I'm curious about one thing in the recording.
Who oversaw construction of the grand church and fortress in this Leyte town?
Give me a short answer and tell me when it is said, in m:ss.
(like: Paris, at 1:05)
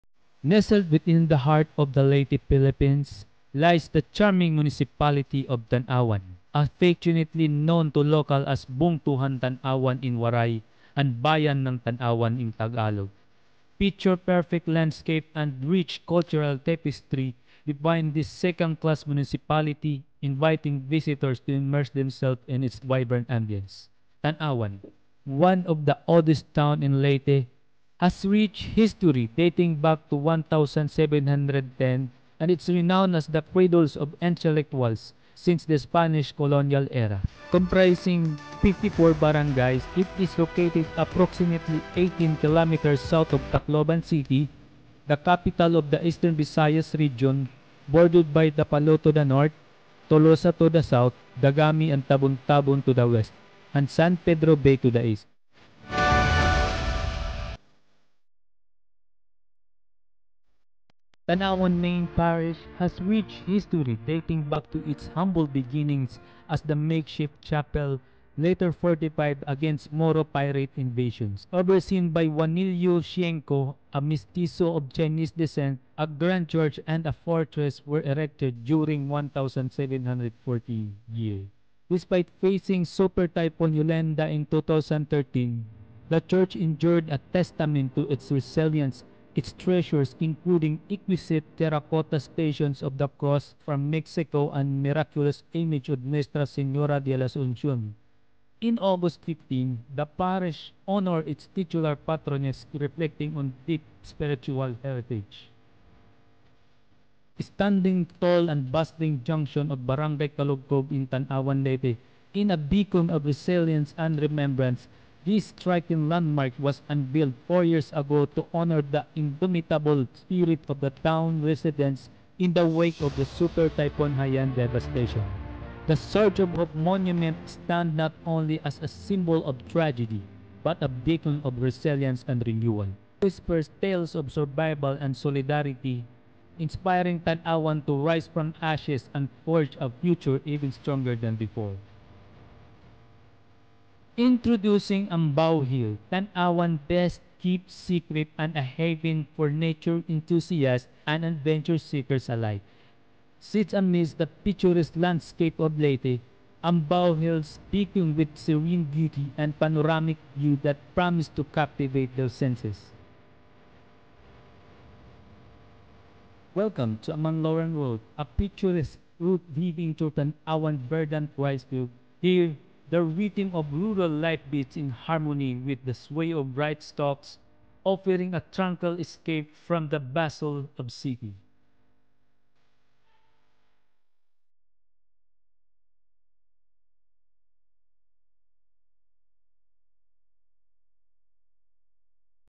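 Juanillo Shienko, at 1:12.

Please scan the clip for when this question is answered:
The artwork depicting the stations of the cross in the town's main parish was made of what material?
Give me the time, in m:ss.
1:31.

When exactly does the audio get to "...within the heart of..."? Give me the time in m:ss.
0:00.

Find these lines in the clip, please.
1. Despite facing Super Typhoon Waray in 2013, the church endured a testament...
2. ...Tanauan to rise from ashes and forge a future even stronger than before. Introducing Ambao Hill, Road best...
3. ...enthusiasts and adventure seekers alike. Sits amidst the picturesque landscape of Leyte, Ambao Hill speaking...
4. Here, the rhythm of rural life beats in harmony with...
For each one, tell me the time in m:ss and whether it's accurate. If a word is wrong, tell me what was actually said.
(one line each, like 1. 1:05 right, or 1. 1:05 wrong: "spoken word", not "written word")
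1. 1:21 wrong: "Yolanda", not "Waray"
2. 2:17 wrong: "Tanauan", not "Road"
3. 2:30 right
4. 2:52 right.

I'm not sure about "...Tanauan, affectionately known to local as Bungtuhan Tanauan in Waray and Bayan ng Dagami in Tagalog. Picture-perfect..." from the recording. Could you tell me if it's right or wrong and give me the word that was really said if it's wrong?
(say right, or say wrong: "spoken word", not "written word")
wrong: "Tanauan", not "Dagami".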